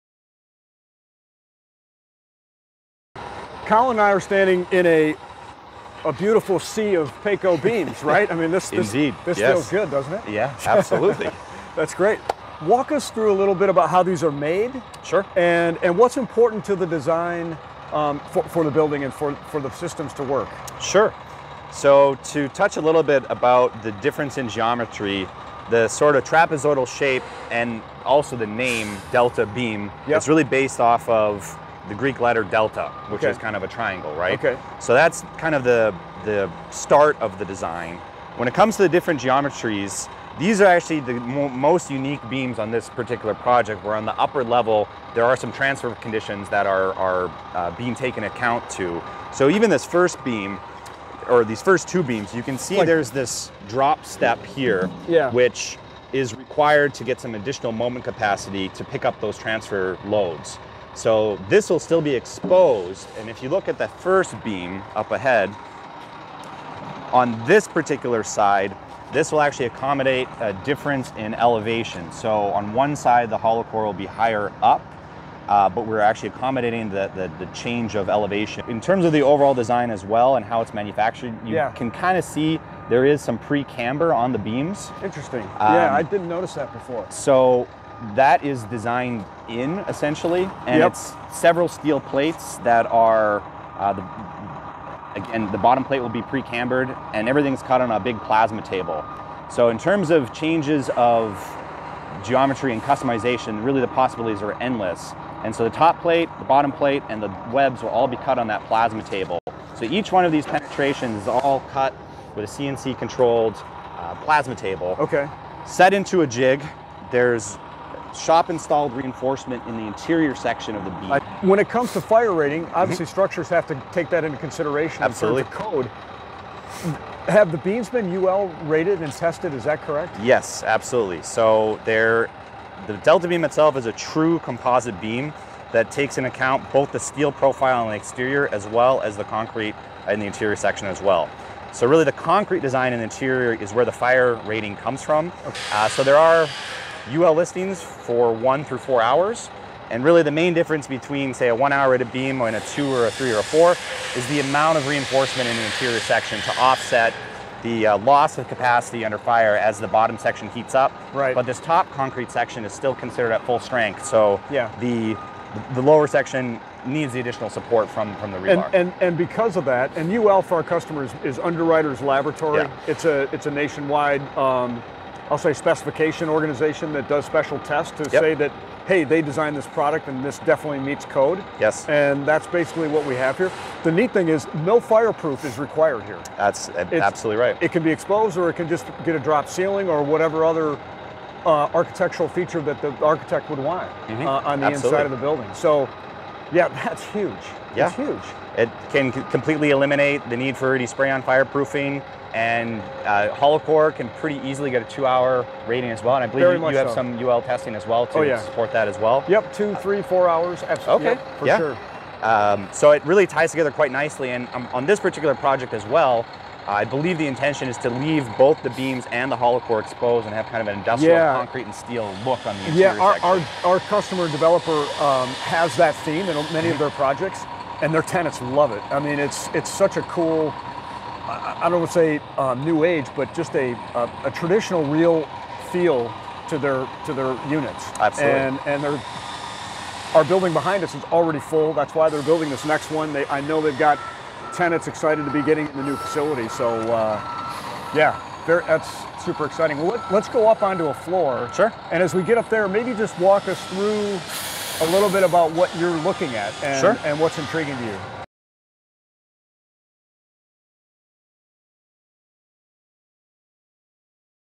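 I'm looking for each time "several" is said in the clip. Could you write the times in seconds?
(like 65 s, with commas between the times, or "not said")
91 s.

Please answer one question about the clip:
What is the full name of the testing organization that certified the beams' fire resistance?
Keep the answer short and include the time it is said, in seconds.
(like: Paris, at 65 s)
Underwriters Laboratory, at 171 s.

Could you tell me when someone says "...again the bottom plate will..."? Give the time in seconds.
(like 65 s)
95 s.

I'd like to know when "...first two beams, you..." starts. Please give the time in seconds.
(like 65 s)
51 s.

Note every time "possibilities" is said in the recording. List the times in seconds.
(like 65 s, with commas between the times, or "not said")
103 s.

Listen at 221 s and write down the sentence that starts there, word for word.
concrete and steel look on the interior.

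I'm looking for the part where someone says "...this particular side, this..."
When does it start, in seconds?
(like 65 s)
67 s.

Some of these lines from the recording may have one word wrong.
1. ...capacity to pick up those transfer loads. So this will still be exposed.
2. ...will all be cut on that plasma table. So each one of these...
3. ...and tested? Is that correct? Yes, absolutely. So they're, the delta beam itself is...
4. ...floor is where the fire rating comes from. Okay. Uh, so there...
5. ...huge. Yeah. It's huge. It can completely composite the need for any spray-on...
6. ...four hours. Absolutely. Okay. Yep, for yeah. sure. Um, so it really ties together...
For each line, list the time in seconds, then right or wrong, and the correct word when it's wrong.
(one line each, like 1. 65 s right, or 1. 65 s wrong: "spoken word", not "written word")
1. 58 s right
2. 107 s right
3. 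129 s right
4. 143 s wrong: "interior", not "floor"
5. 197 s wrong: "eliminate", not "composite"
6. 210 s right.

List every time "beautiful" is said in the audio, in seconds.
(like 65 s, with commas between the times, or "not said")
6 s.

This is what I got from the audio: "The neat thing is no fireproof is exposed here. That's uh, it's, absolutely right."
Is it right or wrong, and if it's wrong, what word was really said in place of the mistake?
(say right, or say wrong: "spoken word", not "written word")
wrong: "required", not "exposed".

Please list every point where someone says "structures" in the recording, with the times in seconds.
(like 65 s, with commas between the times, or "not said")
123 s.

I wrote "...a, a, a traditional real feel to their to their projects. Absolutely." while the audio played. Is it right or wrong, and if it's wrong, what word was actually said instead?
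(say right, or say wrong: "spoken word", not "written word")
wrong: "units", not "projects".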